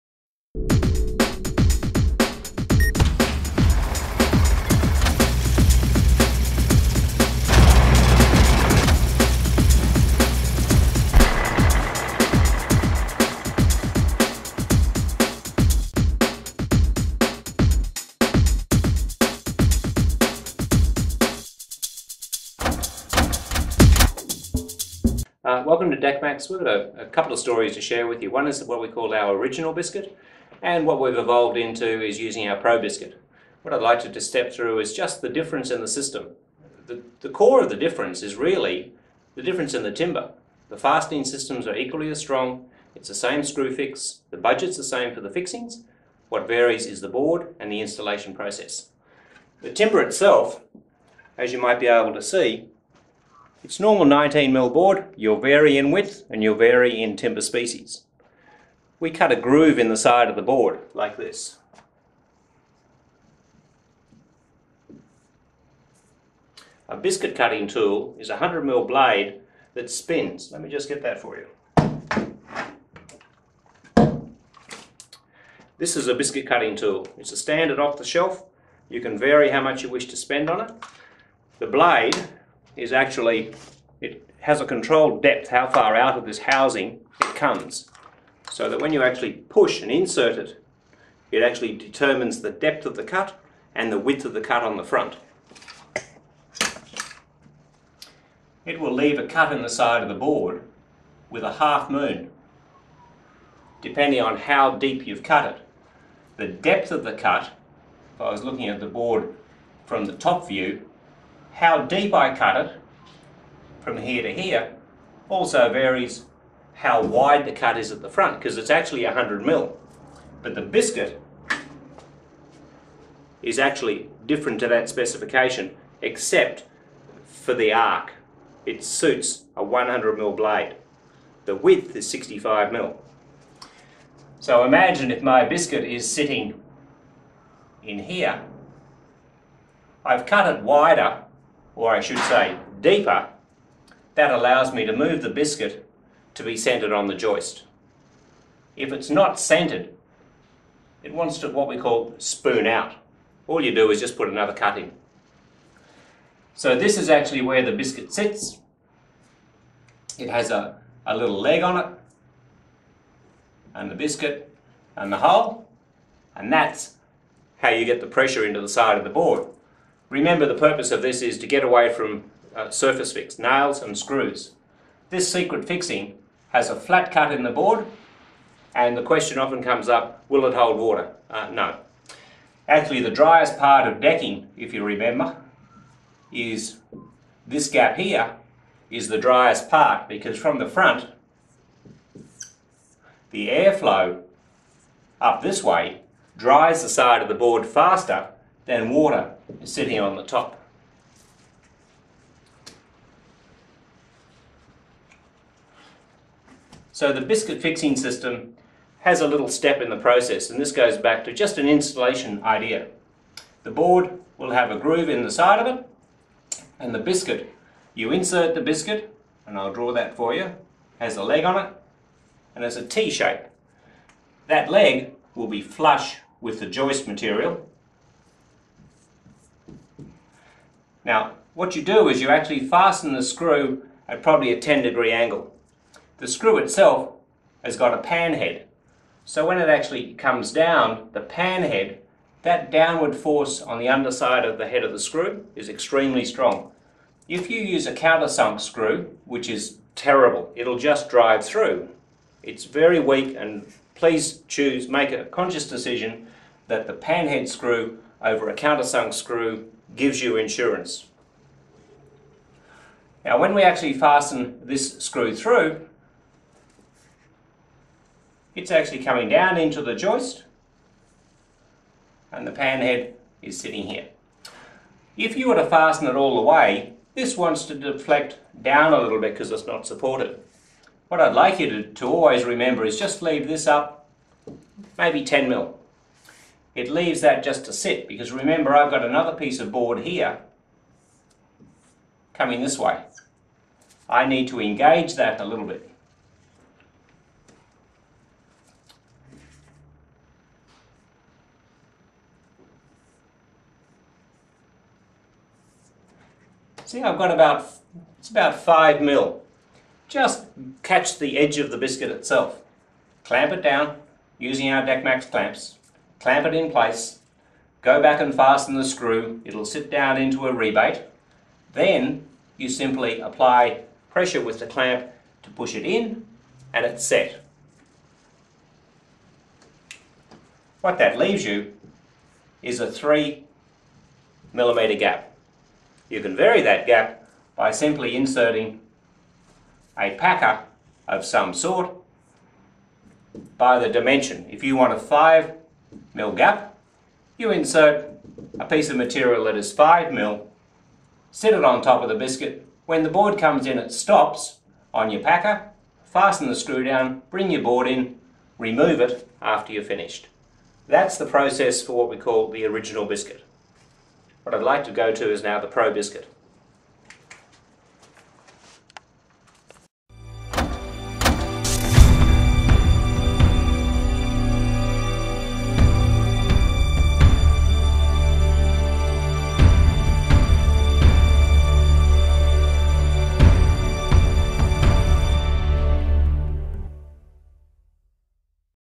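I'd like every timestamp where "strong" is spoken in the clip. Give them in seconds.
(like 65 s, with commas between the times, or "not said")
42 s, 246 s.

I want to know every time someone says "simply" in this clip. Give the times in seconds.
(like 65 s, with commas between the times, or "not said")
322 s, 337 s.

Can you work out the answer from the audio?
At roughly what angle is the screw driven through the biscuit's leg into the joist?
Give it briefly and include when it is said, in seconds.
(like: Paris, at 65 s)
10 degree, at 234 s.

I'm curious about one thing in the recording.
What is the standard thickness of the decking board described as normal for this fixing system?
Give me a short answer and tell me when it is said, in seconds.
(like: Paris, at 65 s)
19 mil, at 54 s.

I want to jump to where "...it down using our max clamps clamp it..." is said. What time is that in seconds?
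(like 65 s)
313 s.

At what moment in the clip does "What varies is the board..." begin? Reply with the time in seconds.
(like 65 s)
46 s.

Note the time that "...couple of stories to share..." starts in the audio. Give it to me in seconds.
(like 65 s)
27 s.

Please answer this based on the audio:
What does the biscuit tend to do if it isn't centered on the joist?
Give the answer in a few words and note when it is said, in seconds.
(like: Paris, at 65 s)
spoon out, at 152 s.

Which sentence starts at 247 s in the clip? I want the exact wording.
If you use a countersunk screw, which is terrible, it'll just drive through.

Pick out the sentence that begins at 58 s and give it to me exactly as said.
We cut a groove in the side of the board like this.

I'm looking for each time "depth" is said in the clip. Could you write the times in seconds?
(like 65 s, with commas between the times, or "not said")
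85 s, 92 s, 106 s.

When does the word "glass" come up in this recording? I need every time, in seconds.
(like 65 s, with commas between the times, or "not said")
not said.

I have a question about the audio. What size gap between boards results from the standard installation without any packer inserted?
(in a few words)
3 millimeter.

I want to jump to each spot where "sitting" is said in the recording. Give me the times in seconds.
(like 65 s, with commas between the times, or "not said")
136 s, 199 s, 273 s.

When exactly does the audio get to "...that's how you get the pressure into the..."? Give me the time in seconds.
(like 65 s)
166 s.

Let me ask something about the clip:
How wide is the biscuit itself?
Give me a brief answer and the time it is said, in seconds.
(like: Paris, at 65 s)
65 mil, at 132 s.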